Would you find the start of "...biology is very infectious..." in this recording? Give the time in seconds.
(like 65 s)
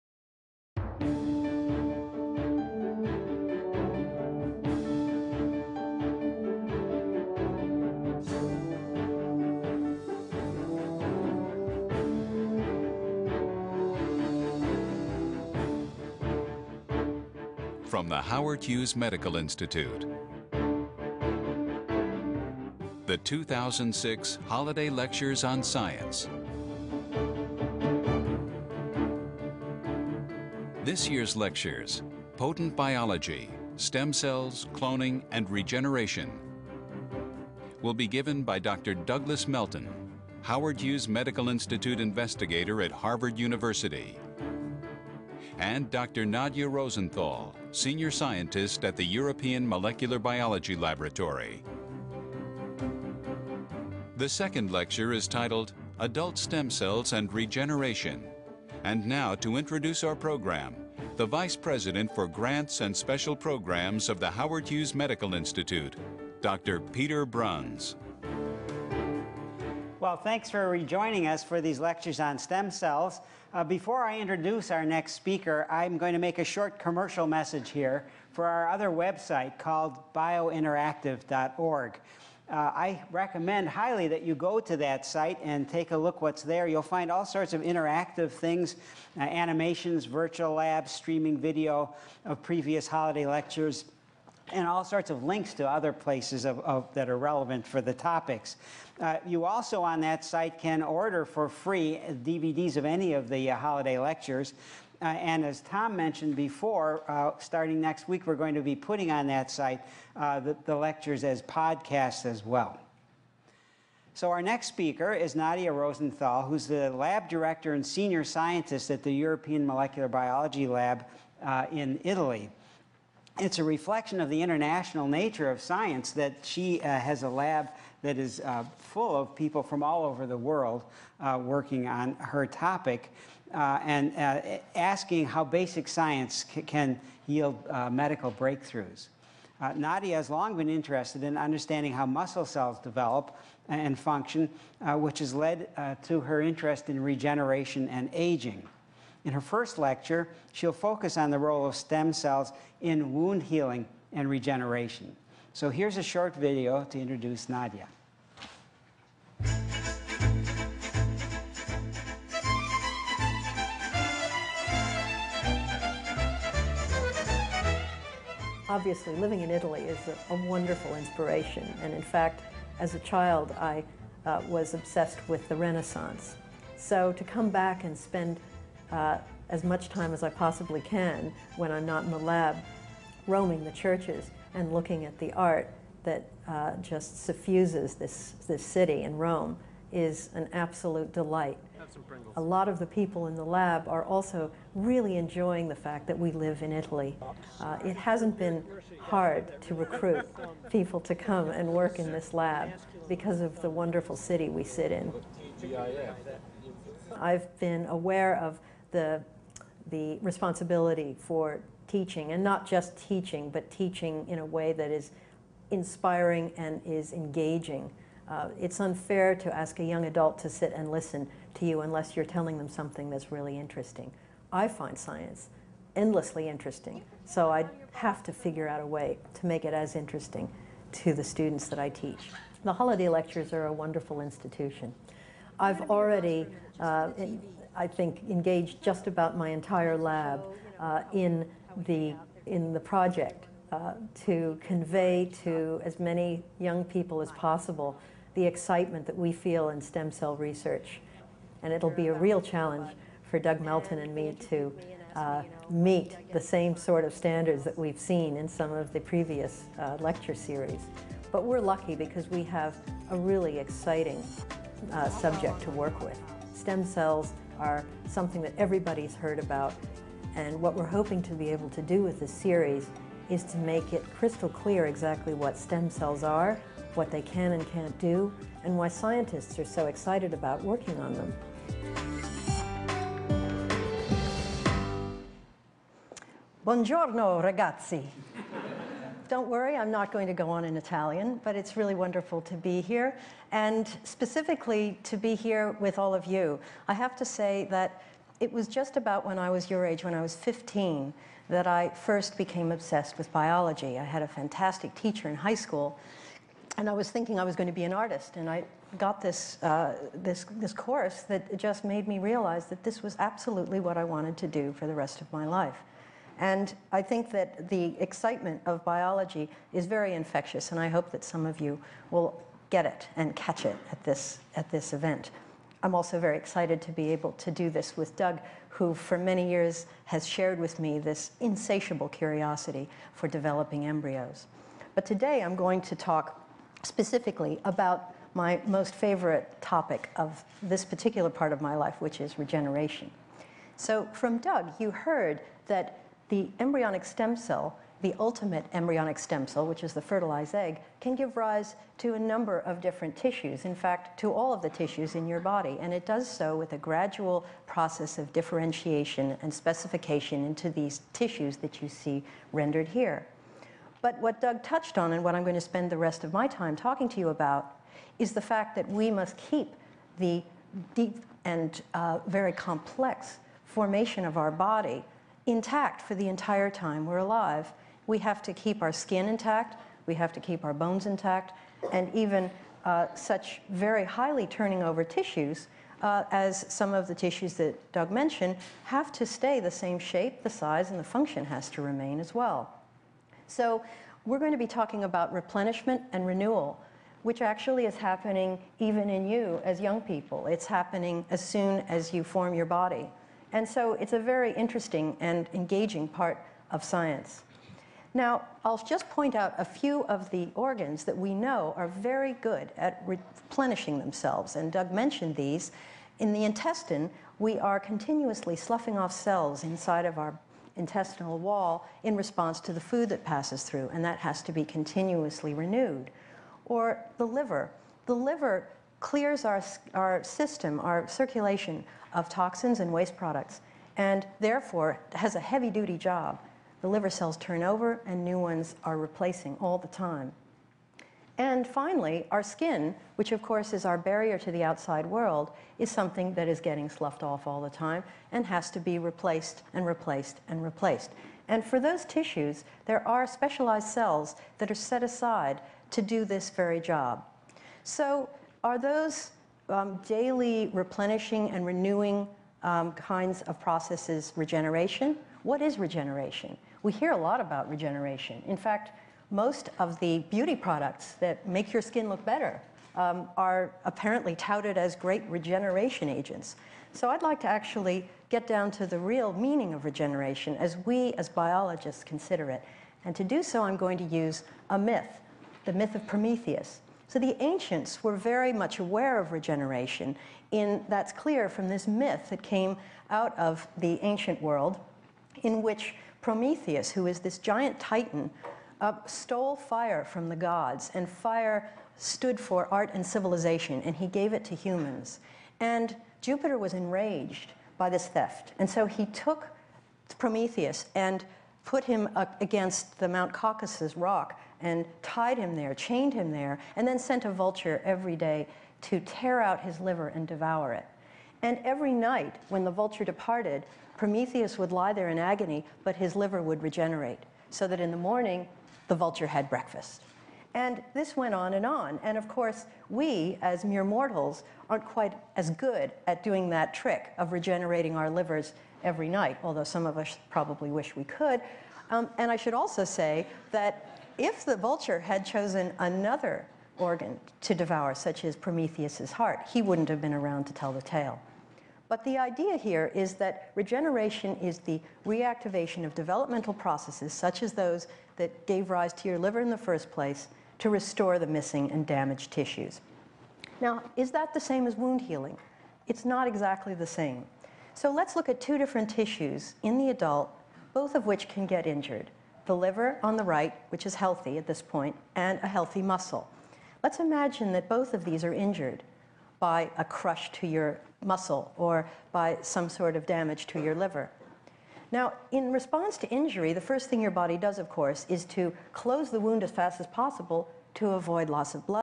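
318 s.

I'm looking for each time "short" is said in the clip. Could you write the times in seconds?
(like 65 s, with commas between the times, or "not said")
76 s, 156 s.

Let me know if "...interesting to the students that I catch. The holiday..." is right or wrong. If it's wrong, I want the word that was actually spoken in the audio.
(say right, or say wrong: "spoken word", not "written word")
wrong: "teach", not "catch".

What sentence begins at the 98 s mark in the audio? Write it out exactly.
Uh, you also on that site can order for free DVDs of any of the uh, holiday lectures.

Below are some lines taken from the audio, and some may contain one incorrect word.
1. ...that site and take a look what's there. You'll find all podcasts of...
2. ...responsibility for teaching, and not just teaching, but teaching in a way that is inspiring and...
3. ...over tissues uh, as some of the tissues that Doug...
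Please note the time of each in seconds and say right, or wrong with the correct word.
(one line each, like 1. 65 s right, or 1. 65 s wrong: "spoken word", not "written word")
1. 84 s wrong: "sorts", not "podcasts"
2. 210 s right
3. 384 s right.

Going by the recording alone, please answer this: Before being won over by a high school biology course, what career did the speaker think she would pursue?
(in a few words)
Artist.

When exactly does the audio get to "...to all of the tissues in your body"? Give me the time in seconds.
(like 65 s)
354 s.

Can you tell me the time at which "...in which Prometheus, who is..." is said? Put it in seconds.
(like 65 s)
495 s.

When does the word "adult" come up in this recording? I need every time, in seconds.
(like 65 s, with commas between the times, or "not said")
55 s, 220 s, 569 s.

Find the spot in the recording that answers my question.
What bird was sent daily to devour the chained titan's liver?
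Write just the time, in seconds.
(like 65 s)
517 s.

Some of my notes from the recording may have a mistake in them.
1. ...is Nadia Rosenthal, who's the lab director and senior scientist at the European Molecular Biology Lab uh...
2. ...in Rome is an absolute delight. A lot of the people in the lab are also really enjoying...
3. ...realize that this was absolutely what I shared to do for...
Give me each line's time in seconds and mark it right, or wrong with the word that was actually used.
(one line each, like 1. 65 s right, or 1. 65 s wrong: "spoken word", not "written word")
1. 115 s right
2. 189 s right
3. 312 s wrong: "wanted", not "shared".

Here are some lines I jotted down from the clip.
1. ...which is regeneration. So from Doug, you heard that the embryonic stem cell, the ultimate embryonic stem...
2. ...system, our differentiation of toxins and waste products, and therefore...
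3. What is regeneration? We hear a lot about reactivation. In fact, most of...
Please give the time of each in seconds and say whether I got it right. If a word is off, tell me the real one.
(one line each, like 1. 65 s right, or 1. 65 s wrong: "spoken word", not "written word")
1. 342 s right
2. 430 s wrong: "circulation", not "differentiation"
3. 465 s wrong: "regeneration", not "reactivation".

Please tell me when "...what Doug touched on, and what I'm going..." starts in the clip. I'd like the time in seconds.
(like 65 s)
364 s.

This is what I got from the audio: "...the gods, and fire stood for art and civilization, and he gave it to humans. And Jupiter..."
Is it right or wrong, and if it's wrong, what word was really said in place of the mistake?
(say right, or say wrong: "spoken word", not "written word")
right.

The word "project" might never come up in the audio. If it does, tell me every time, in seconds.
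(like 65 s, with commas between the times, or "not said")
242 s.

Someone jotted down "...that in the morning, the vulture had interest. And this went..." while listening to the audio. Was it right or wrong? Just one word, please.
wrong.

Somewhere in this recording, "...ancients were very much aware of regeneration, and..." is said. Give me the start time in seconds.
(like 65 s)
487 s.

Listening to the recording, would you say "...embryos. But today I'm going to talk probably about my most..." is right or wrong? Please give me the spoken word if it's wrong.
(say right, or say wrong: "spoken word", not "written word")
wrong: "specifically", not "probably".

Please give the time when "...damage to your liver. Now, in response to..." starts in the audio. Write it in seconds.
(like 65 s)
583 s.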